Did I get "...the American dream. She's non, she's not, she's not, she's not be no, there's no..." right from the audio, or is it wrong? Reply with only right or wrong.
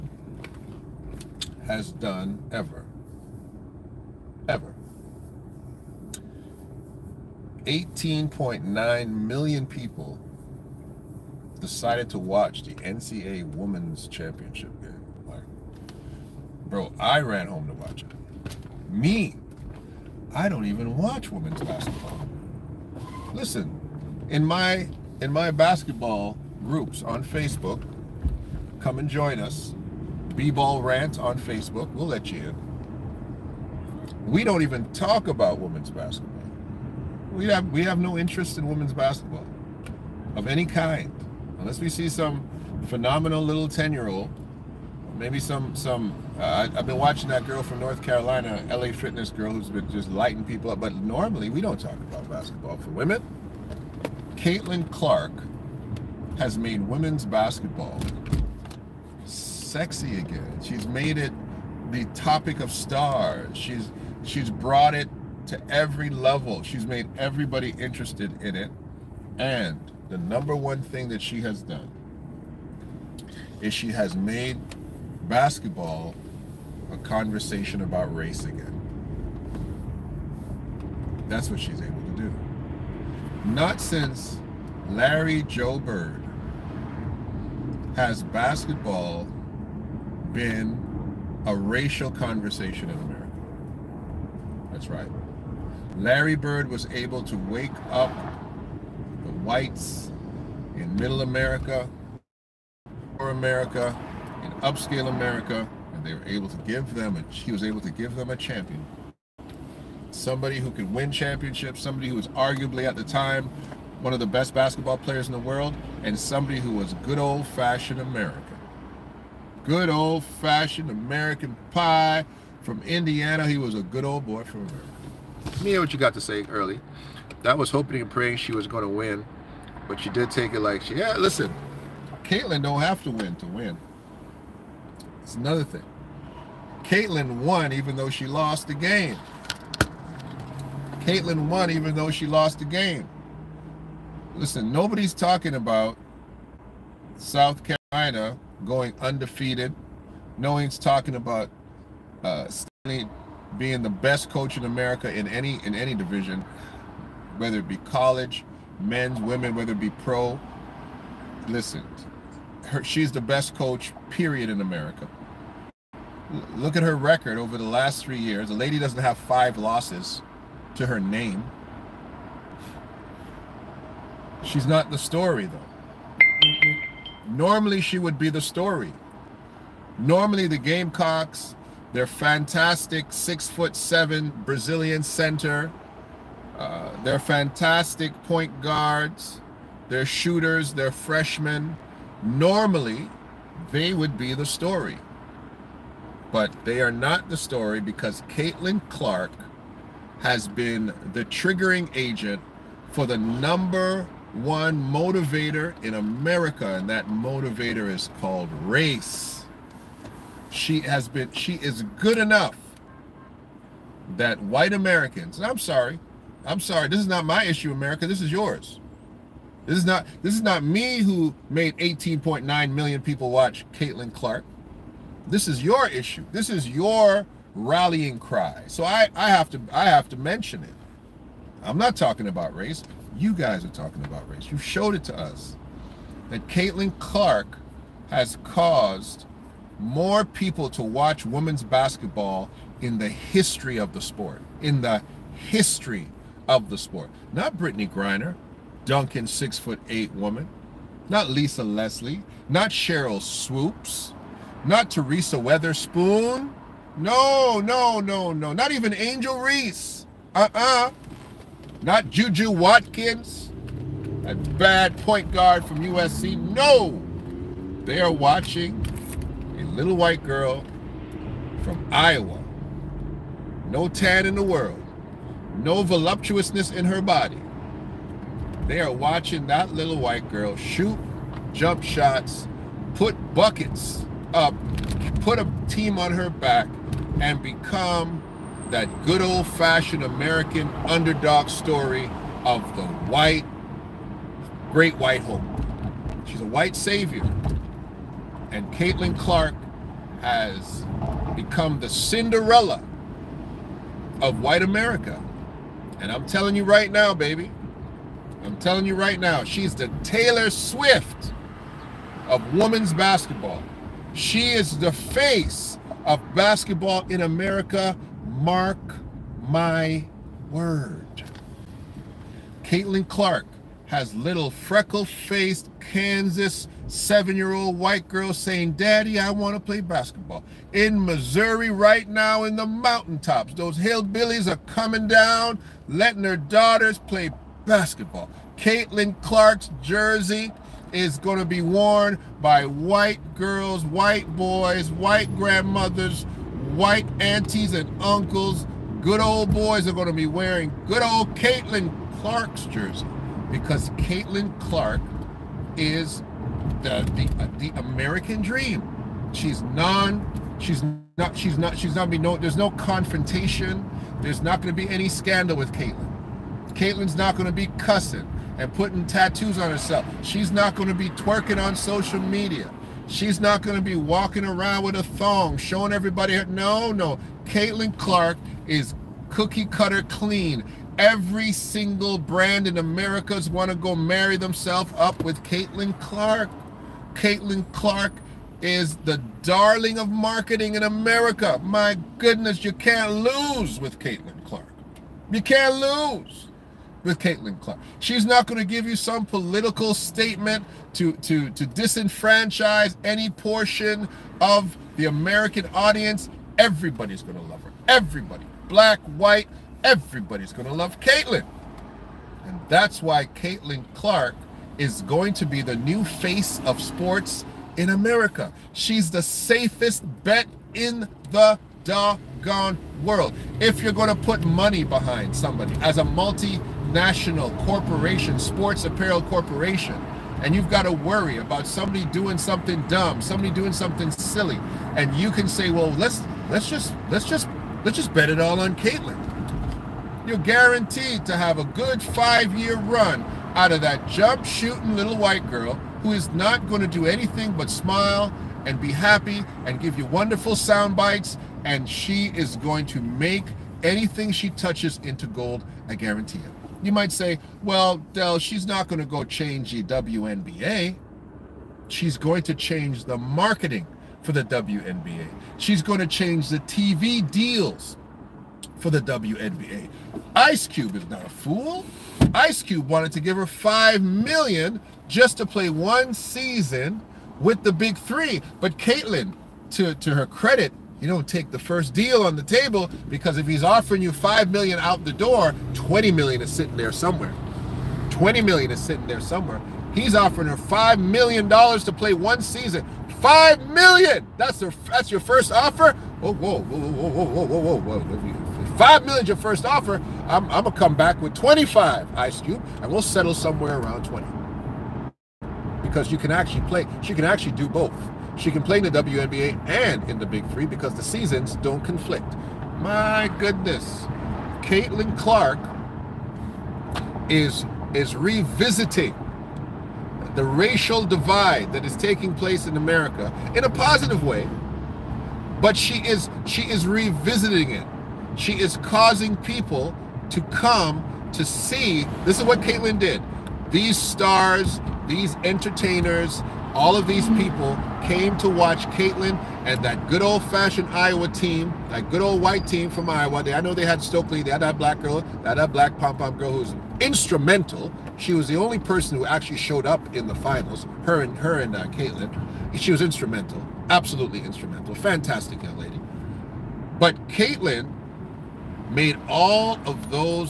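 right.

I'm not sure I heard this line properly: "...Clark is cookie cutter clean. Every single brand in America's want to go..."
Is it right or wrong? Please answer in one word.
right.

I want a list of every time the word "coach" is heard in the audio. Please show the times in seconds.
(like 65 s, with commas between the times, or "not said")
154 s, 163 s.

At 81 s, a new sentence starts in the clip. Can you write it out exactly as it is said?
That's what she's able not since Larry Joe Bird has basketball been a racial conversation in America.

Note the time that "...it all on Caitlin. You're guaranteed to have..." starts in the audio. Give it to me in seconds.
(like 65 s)
438 s.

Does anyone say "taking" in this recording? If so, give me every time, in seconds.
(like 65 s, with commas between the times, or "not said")
521 s.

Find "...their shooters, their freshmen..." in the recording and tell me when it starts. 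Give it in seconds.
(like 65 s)
189 s.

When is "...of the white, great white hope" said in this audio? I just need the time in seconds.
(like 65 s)
292 s.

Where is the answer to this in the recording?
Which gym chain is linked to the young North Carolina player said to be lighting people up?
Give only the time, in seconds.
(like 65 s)
48 s.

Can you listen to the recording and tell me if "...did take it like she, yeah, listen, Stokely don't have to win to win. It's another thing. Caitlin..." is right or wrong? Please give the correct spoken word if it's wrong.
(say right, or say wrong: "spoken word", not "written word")
wrong: "Caitlin", not "Stokely".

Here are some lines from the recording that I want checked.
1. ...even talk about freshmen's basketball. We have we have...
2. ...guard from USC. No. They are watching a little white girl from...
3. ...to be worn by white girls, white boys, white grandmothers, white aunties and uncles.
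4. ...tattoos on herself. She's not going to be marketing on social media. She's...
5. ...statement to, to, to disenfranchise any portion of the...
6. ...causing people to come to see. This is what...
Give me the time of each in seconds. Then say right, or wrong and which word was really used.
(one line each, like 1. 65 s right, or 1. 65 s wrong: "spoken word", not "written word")
1. 34 s wrong: "women", not "freshmen"
2. 265 s right
3. 341 s right
4. 369 s wrong: "twerking", not "marketing"
5. 399 s right
6. 528 s right.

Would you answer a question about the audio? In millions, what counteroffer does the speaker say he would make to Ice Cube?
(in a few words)
25.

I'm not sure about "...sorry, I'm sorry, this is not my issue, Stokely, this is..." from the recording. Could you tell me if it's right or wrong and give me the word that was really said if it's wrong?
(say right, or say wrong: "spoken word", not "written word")
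wrong: "America", not "Stokely".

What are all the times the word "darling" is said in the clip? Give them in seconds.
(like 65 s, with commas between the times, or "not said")
389 s.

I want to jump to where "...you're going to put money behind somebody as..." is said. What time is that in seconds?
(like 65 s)
423 s.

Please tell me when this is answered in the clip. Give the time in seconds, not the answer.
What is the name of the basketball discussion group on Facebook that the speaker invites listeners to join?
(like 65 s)
30 s.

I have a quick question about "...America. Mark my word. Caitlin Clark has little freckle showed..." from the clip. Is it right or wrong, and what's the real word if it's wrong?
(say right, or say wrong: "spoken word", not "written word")
wrong: "faced", not "showed".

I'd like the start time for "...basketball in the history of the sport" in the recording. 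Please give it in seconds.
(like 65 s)
241 s.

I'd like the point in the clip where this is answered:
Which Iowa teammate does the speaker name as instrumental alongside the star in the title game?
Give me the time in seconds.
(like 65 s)
544 s.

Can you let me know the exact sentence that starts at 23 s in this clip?
Listen, in my in my basketball groups on Facebook.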